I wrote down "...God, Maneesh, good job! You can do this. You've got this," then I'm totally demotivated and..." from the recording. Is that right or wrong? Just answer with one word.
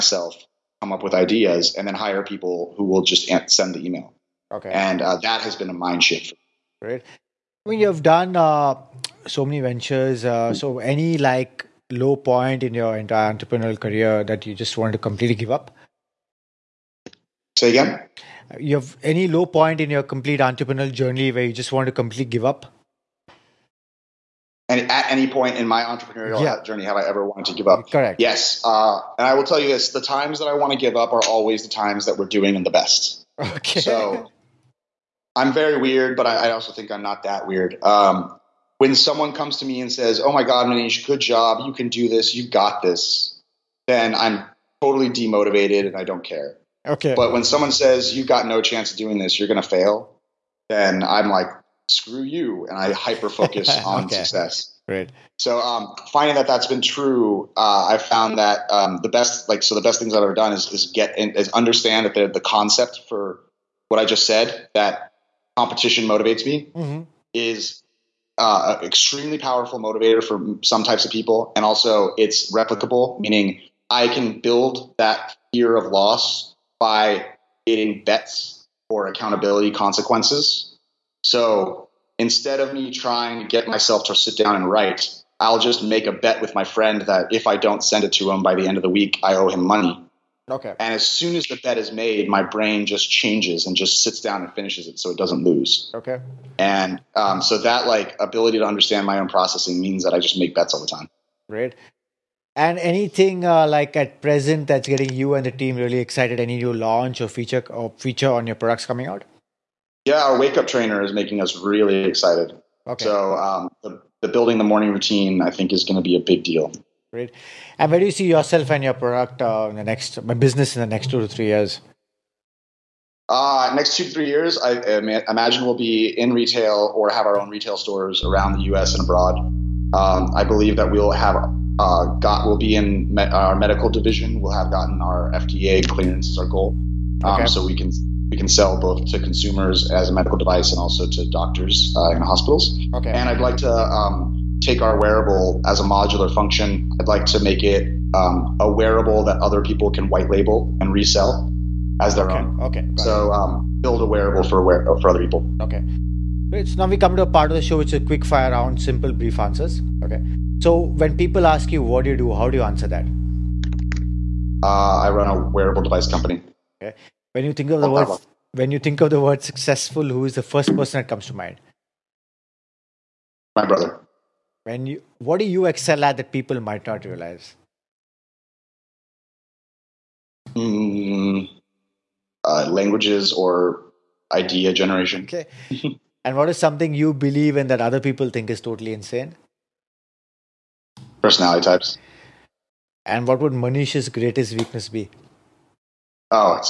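right.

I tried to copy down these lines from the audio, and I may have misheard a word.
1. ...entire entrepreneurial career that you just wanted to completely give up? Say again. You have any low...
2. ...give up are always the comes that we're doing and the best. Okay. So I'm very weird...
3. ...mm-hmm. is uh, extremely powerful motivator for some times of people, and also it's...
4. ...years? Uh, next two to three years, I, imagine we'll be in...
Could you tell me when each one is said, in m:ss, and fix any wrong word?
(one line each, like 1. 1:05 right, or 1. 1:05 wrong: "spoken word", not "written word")
1. 0:12 right
2. 0:30 wrong: "times", not "comes"
3. 1:06 wrong: "types", not "times"
4. 2:01 right.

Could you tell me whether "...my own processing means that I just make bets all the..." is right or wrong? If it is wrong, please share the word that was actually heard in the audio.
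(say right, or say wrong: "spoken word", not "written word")
right.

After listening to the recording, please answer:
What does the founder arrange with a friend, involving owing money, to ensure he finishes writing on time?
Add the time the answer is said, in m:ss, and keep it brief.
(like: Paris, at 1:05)
A bet, at 1:25.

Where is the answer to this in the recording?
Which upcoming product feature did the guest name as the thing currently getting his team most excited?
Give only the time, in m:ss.
1:50.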